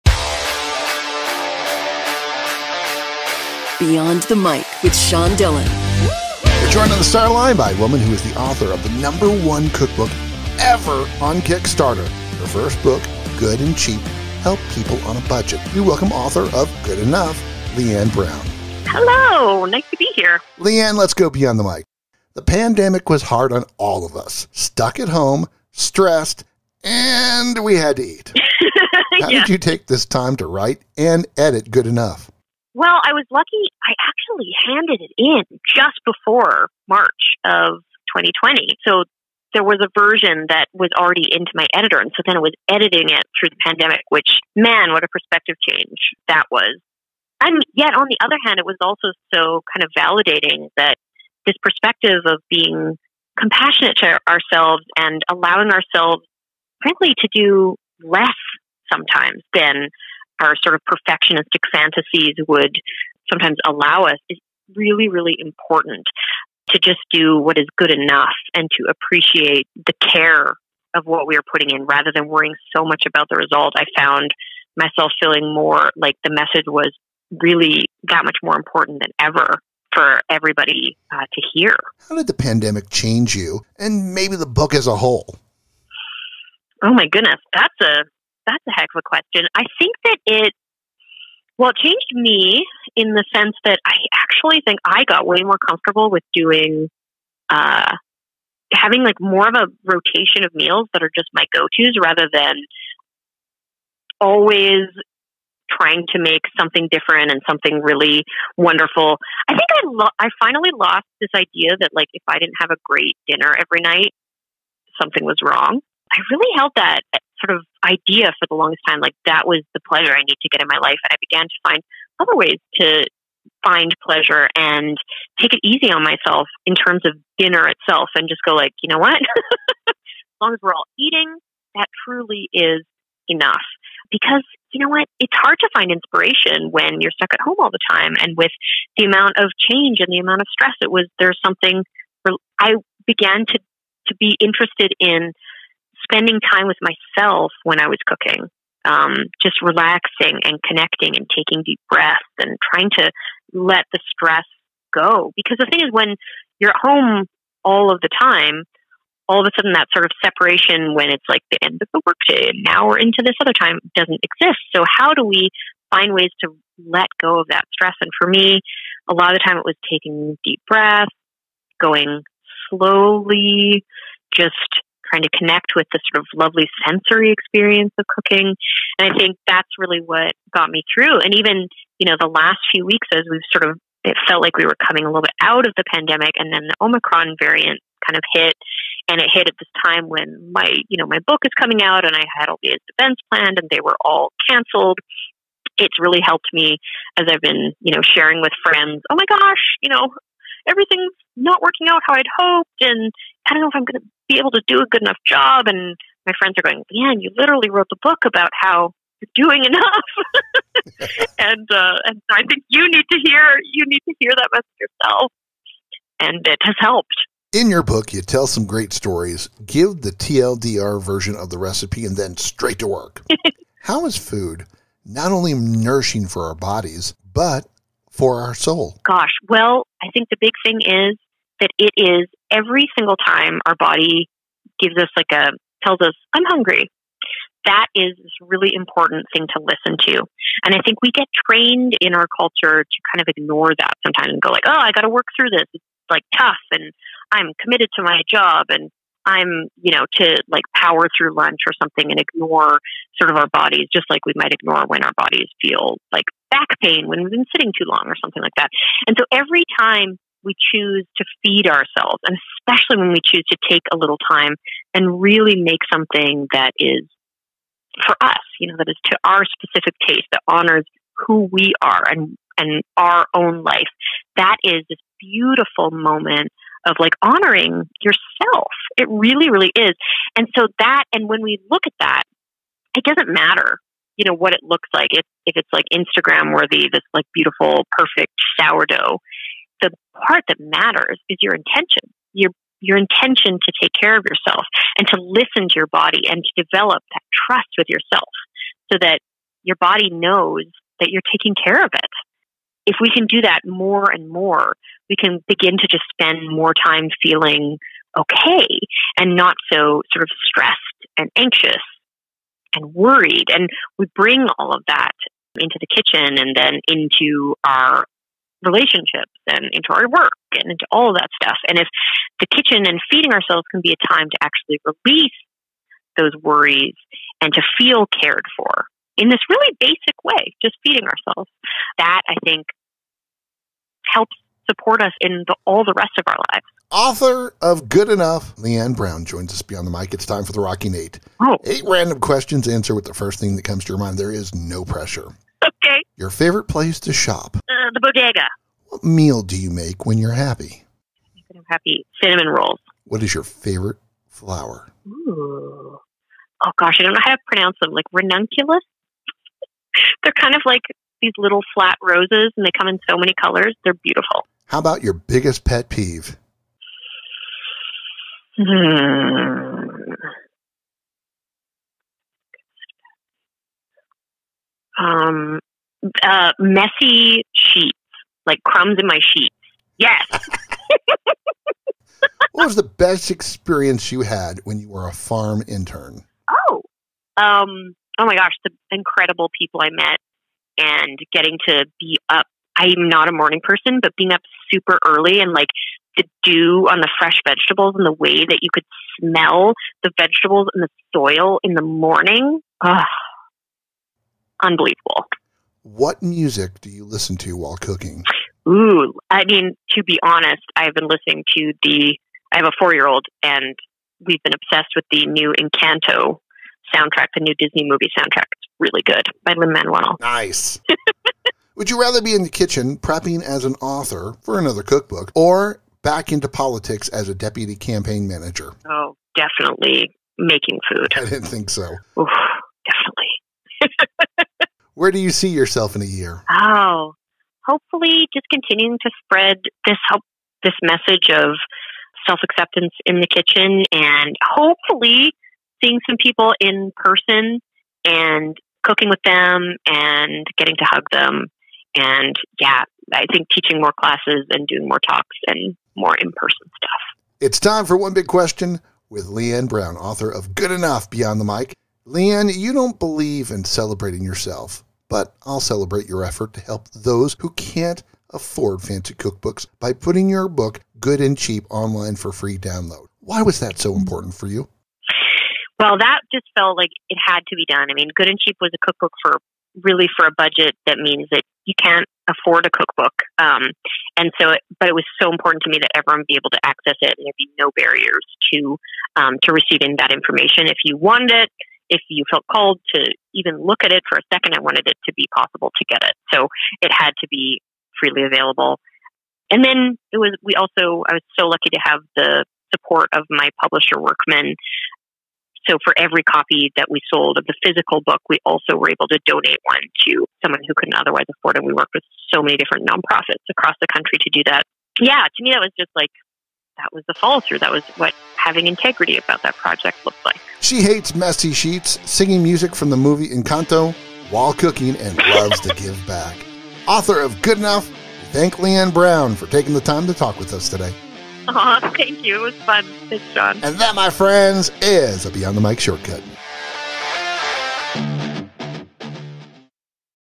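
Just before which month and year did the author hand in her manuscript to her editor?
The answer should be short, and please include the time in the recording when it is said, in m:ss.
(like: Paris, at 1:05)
March 2020, at 0:36.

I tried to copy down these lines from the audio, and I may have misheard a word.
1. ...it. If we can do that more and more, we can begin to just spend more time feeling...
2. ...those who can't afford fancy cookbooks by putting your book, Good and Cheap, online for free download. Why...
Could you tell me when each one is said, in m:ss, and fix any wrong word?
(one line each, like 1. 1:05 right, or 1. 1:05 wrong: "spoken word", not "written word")
1. 5:01 right
2. 7:46 right.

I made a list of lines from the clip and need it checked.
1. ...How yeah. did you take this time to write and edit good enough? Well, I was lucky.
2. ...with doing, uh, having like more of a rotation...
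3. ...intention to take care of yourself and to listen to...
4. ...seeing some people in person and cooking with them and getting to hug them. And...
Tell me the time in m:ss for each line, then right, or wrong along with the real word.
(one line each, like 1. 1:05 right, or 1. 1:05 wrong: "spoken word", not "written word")
1. 0:29 right
2. 1:36 right
3. 4:52 right
4. 7:25 right.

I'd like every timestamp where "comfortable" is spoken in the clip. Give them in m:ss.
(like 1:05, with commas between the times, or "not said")
1:35.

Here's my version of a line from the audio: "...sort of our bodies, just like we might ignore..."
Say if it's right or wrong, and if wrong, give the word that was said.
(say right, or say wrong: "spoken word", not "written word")
right.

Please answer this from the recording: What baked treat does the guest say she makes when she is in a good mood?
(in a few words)
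Cinnamon rolls.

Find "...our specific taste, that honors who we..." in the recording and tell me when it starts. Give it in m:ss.
4:29.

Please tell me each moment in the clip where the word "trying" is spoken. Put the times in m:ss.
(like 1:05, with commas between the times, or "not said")
1:45, 2:32, 2:55.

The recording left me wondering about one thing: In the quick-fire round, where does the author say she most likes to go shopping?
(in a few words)
The bodega.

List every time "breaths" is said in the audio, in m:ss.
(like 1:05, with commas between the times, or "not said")
2:31, 2:50.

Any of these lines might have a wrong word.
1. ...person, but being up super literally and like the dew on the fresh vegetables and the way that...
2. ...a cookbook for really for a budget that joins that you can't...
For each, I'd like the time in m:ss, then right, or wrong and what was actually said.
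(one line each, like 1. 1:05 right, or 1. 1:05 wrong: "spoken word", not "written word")
1. 6:33 wrong: "early", not "literally"
2. 7:58 wrong: "means", not "joins".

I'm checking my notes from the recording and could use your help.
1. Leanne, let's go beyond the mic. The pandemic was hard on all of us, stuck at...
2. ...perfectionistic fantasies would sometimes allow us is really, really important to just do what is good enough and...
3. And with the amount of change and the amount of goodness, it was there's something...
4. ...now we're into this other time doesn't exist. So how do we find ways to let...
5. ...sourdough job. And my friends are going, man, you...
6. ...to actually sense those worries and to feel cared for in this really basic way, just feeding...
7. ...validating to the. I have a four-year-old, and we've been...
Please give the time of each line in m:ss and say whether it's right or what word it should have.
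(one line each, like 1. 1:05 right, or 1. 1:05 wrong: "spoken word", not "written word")
1. 0:20 right
2. 1:00 right
3. 2:18 wrong: "stress", not "goodness"
4. 2:42 right
5. 3:25 wrong: "enough", not "sourdough"
6. 5:24 wrong: "release", not "sense"
7. 6:51 wrong: "listening", not "validating".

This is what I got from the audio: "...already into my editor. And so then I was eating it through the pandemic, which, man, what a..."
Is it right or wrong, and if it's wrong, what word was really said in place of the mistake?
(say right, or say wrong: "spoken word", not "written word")
wrong: "editing", not "eating".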